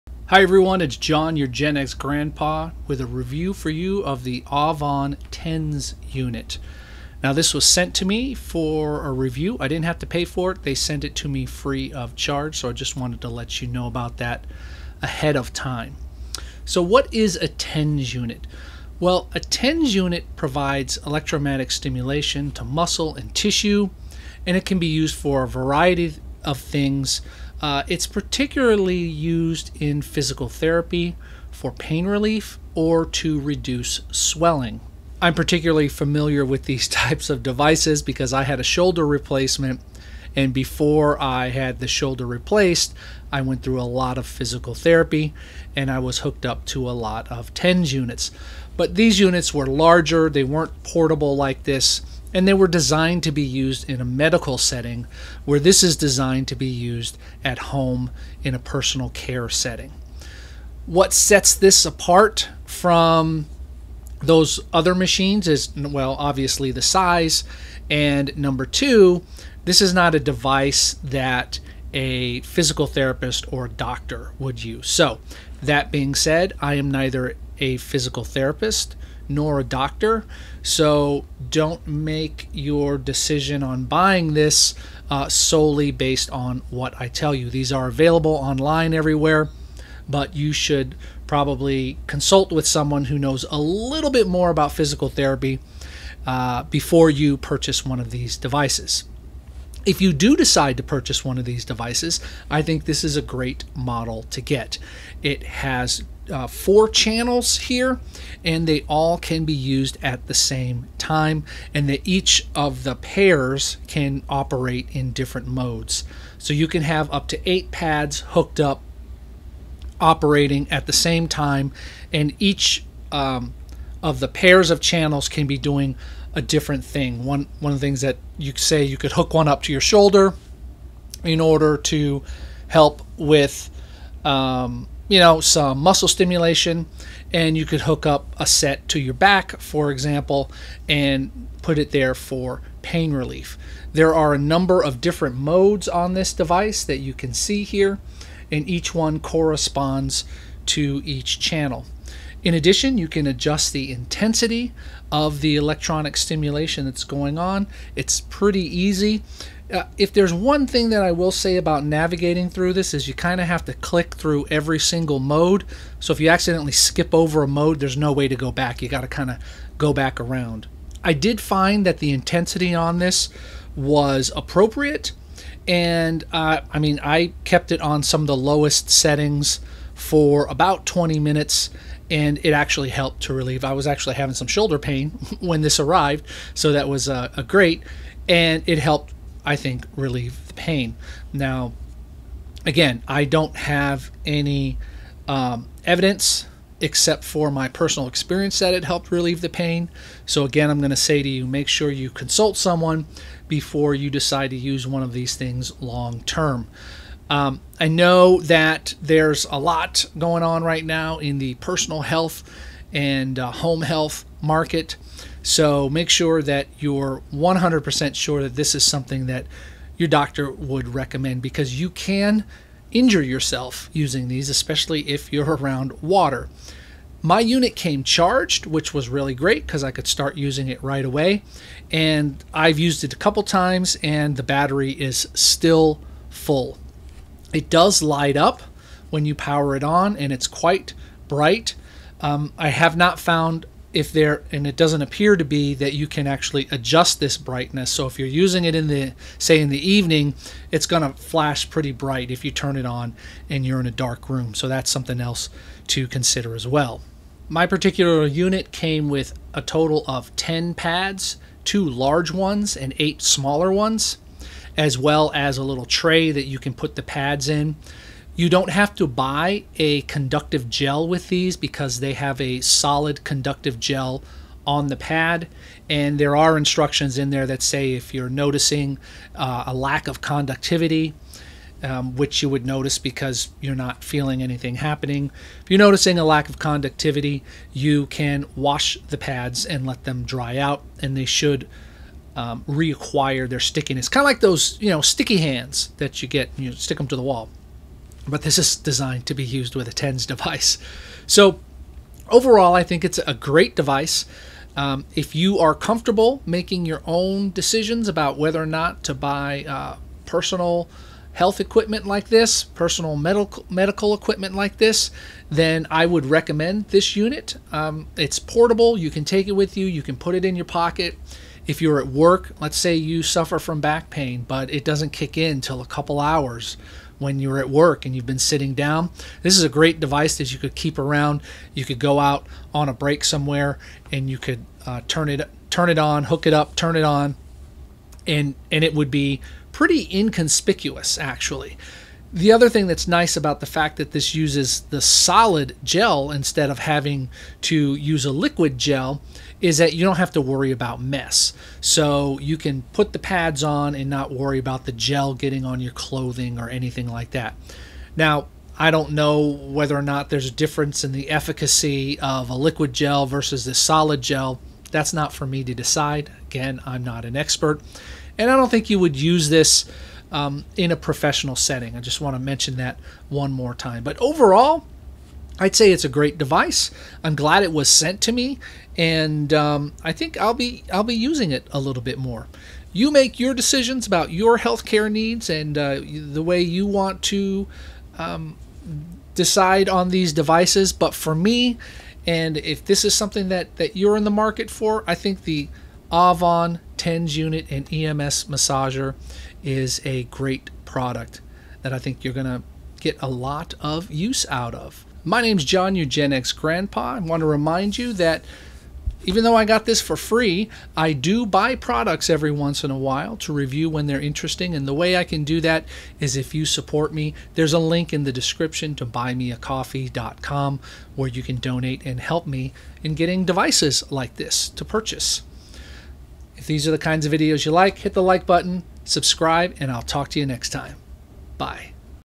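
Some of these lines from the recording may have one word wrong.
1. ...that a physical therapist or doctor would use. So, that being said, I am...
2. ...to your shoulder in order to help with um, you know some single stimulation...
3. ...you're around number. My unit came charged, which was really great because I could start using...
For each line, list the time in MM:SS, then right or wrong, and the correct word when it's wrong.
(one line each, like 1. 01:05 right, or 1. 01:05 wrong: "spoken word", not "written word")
1. 01:11 right
2. 02:09 wrong: "muscle", not "single"
3. 03:45 wrong: "water", not "number".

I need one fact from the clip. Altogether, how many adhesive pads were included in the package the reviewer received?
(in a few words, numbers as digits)
10.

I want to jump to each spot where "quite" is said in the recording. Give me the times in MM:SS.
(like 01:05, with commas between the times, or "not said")
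04:00.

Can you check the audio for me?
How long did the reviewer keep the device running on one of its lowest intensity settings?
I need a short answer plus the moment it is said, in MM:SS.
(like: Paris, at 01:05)
20 minutes, at 03:00.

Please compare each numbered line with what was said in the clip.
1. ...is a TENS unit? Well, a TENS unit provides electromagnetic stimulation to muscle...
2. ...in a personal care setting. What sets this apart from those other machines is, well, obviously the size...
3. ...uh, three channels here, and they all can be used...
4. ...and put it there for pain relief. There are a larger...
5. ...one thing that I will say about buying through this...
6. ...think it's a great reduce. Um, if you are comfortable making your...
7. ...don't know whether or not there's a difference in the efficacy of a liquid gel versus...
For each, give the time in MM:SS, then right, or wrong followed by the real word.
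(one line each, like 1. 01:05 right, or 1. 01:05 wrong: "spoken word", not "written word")
1. 00:17 right
2. 00:58 right
3. 01:46 wrong: "four", not "three"
4. 02:20 wrong: "number", not "larger"
5. 02:40 wrong: "navigating", not "buying"
6. 05:02 wrong: "device", not "reduce"
7. 05:58 right.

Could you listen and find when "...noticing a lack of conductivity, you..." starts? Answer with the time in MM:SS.
04:45.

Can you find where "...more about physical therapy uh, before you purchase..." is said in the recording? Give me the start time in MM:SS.
01:34.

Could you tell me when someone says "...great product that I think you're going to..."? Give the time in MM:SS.
06:40.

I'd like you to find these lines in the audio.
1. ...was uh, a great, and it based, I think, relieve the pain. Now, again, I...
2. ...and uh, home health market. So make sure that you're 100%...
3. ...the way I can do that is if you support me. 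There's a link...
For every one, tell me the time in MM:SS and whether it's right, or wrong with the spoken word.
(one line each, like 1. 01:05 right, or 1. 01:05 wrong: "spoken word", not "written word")
1. 03:06 wrong: "helped", not "based"
2. 03:32 right
3. 06:54 right.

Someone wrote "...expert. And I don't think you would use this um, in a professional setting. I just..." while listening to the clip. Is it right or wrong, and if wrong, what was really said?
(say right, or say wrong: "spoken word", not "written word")
right.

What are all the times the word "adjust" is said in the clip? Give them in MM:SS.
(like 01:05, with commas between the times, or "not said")
02:33, 04:06.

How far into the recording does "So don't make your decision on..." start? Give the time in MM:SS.
01:20.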